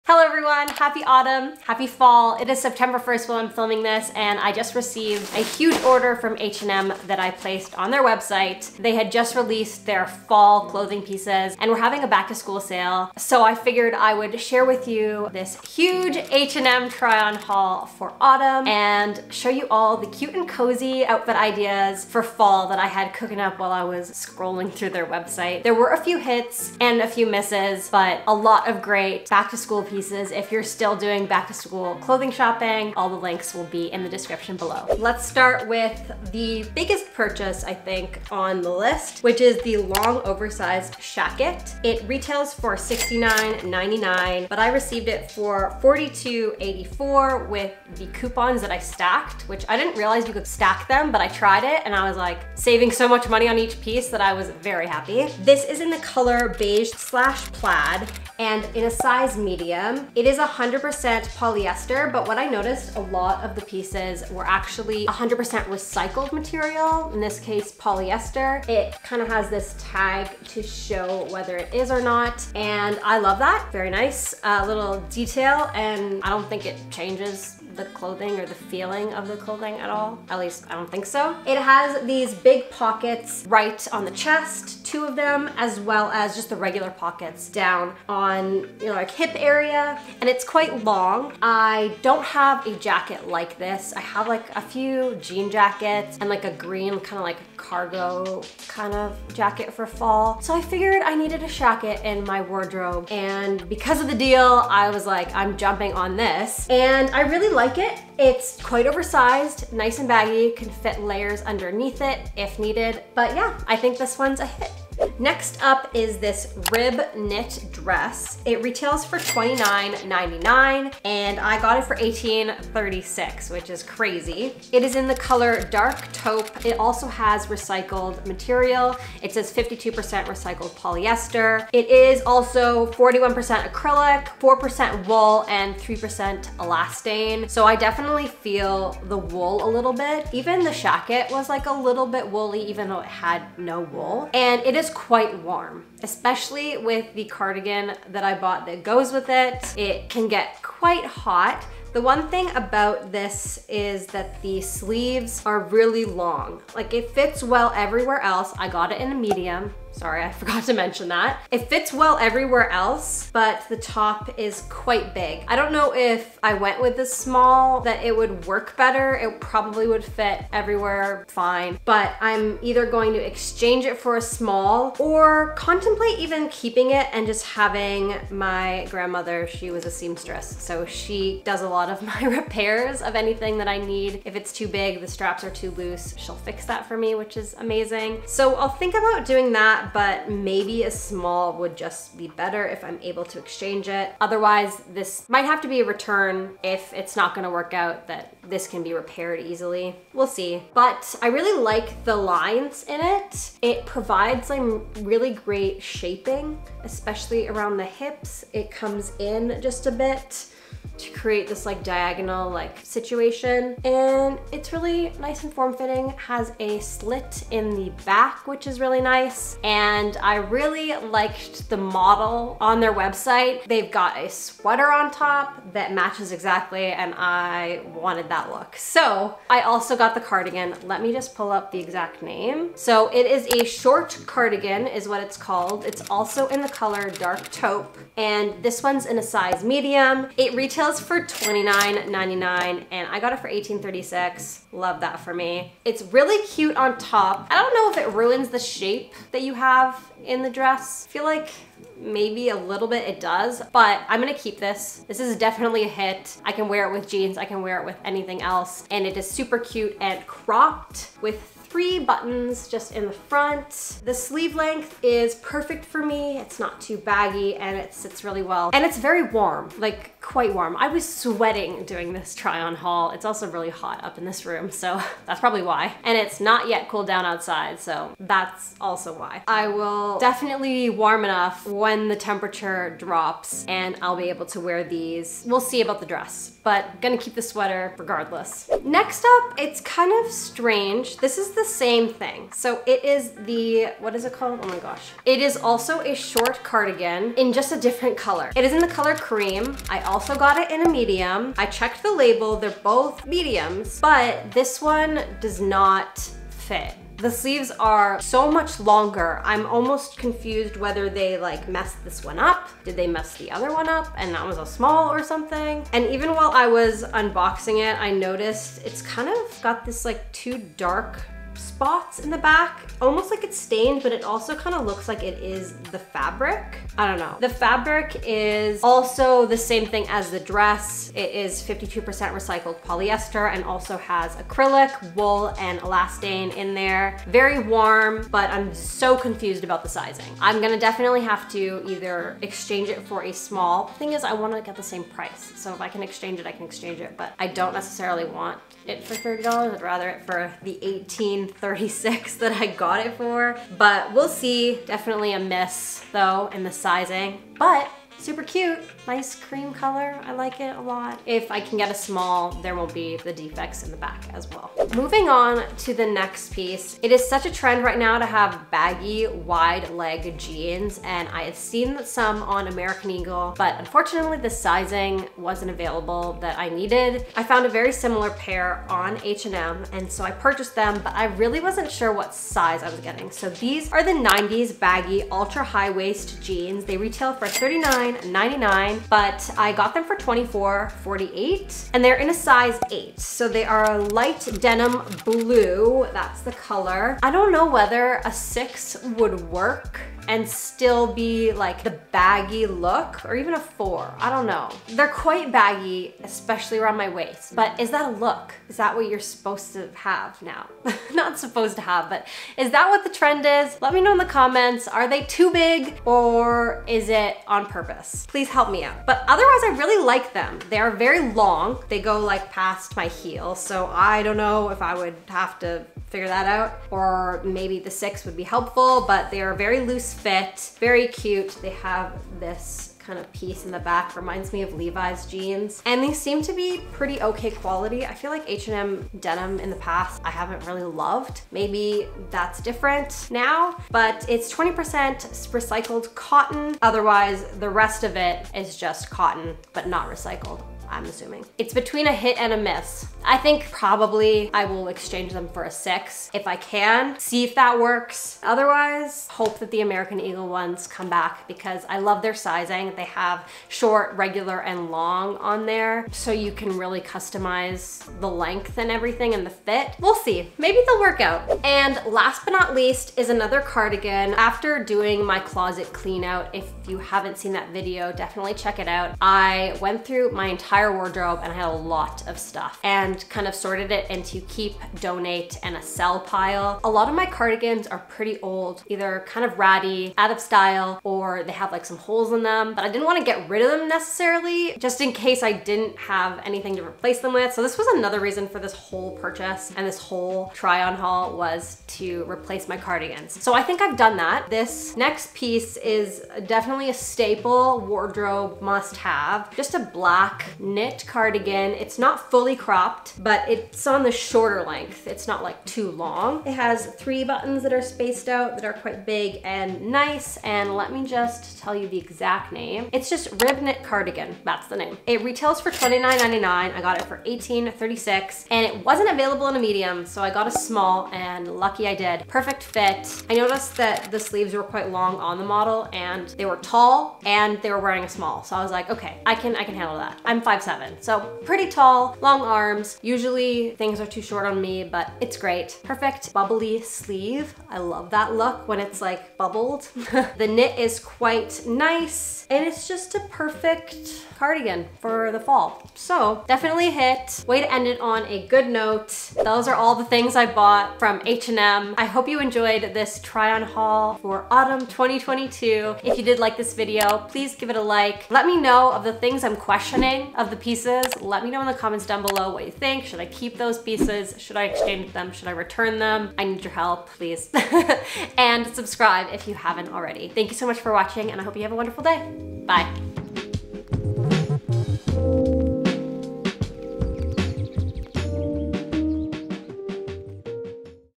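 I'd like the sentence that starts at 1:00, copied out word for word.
It is 100% polyester, but what I noticed a lot of the pieces were actually 100% recycled material, in this case polyester.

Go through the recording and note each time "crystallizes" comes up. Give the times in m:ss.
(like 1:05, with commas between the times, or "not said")
not said.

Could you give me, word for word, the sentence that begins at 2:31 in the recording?
The one thing about this is that the sleeves are really long.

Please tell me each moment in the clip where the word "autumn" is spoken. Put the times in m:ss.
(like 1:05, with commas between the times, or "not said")
0:01, 0:18, 9:24.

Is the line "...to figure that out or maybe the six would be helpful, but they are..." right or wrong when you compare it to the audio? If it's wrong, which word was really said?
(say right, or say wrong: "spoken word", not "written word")
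right.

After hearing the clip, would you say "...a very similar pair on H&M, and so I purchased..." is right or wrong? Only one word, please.
right.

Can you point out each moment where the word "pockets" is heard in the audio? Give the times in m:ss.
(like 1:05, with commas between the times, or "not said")
1:22, 1:26.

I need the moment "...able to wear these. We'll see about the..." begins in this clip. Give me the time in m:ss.
4:44.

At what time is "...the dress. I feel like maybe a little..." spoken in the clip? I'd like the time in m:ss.
4:10.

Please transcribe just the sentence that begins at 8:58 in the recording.
So I was like, okay, I can, I can handle that.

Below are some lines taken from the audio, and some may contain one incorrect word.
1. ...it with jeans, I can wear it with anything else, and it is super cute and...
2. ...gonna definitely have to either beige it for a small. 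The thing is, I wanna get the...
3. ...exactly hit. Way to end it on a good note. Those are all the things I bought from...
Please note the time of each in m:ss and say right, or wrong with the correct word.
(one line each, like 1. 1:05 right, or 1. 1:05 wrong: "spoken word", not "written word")
1. 4:16 right
2. 5:40 wrong: "exchange", not "beige"
3. 9:16 wrong: "definitely", not "exactly".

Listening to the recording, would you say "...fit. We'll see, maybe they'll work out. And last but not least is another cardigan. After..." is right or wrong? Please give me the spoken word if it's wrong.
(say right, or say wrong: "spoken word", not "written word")
right.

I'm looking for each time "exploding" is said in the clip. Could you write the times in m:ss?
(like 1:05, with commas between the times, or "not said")
not said.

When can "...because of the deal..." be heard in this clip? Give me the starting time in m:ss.
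1:43.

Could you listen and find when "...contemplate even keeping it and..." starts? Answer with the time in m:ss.
2:55.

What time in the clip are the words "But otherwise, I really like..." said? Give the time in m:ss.
6:59.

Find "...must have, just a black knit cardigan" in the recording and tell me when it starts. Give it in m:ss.
8:28.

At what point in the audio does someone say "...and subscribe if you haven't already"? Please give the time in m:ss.
9:38.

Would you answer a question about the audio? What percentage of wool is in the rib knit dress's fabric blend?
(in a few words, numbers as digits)
4%.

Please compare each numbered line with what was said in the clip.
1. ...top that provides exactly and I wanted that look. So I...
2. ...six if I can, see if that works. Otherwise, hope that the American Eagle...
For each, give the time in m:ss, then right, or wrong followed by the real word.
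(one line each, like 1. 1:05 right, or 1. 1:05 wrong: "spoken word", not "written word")
1. 3:45 wrong: "matches", not "provides"
2. 7:35 right.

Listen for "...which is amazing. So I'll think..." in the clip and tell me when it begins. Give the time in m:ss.
3:07.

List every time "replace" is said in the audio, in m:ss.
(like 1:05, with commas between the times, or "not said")
8:16, 8:22.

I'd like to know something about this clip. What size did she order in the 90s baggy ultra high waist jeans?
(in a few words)
8.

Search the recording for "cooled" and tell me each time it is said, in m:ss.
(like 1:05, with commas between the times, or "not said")
4:36.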